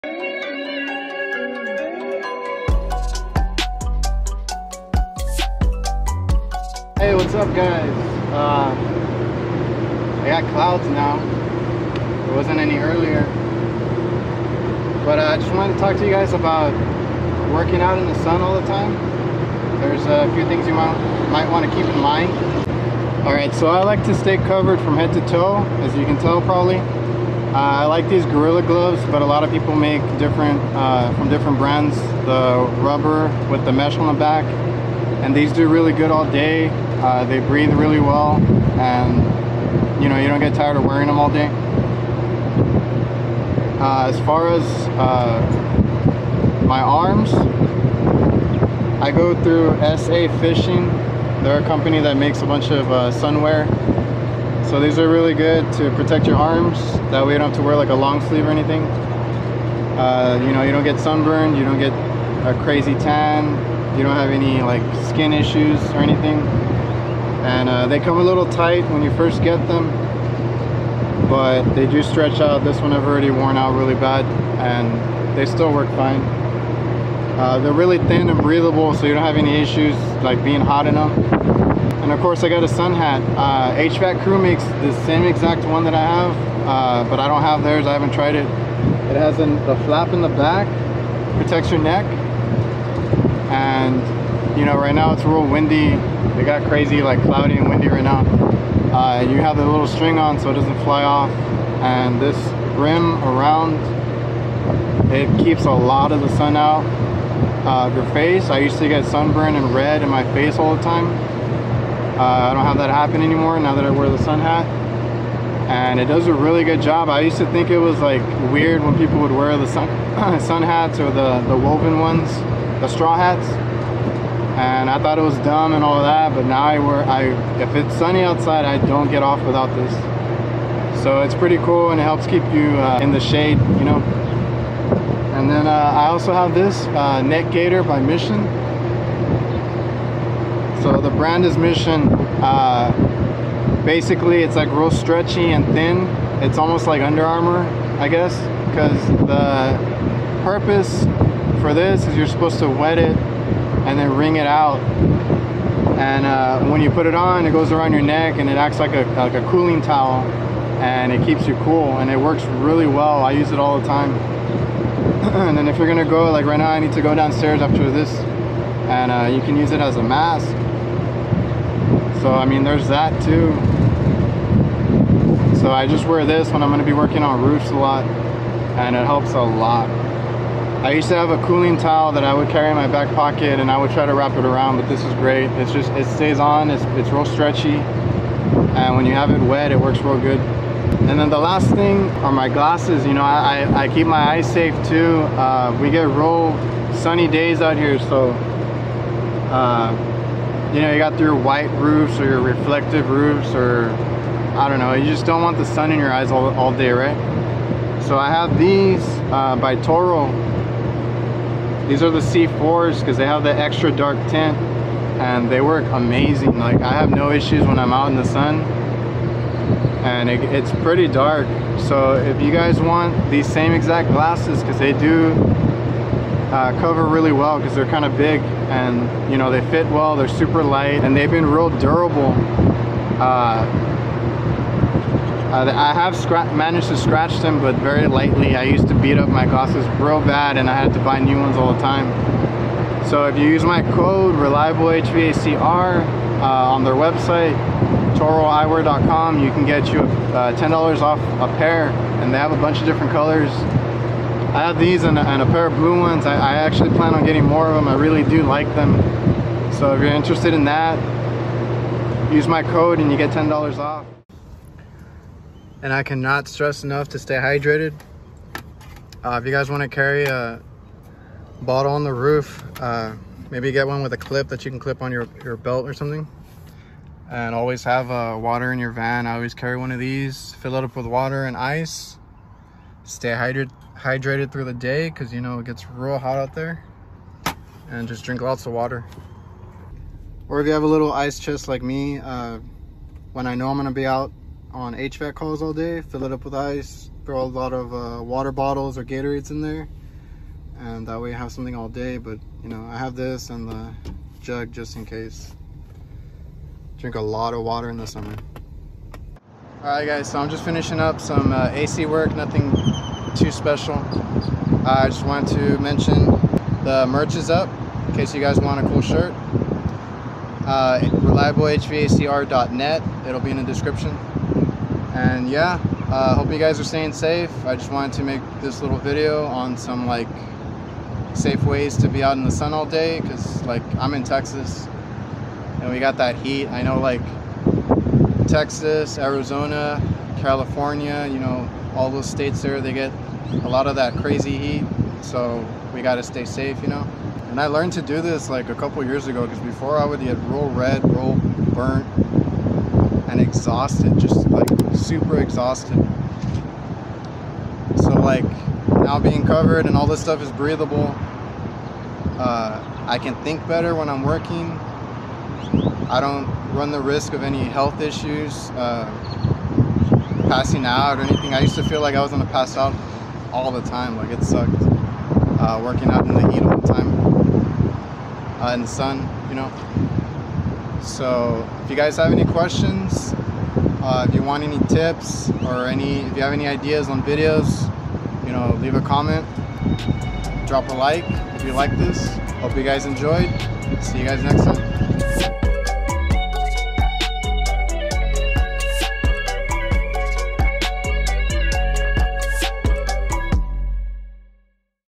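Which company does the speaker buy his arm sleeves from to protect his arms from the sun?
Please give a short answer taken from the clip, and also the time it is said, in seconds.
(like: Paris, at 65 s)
SA Fishing, at 49 s.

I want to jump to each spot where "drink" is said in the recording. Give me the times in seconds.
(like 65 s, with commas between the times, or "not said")
288 s, 306 s.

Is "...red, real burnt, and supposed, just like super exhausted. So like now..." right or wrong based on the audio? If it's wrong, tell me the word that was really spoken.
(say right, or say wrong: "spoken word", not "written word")
wrong: "exhausted", not "supposed".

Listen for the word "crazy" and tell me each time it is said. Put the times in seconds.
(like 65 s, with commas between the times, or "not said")
62 s, 96 s, 344 s.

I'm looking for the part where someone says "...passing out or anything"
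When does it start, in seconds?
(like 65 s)
370 s.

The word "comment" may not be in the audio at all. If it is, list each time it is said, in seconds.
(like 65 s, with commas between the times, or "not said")
389 s.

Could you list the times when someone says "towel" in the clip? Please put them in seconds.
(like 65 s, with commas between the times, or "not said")
159 s, 181 s.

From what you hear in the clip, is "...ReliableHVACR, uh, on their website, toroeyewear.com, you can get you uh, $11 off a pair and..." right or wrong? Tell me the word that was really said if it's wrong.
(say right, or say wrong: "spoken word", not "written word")
wrong: "10", not "11".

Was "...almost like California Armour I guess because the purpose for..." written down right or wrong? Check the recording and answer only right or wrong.
wrong.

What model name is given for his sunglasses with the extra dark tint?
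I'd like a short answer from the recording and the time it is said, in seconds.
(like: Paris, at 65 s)
C4, at 212 s.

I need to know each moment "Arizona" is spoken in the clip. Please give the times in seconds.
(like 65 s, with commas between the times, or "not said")
339 s.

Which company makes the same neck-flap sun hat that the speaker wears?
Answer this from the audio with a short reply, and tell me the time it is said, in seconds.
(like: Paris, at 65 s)
HVAC crew, at 83 s.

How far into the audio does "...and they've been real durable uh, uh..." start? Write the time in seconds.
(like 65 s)
231 s.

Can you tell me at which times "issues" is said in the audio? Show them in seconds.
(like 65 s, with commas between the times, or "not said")
65 s, 79 s, 217 s, 368 s.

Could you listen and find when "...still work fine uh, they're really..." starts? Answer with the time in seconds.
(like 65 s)
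75 s.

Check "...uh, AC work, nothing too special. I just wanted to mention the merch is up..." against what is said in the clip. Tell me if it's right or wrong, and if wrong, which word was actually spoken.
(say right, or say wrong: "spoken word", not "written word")
right.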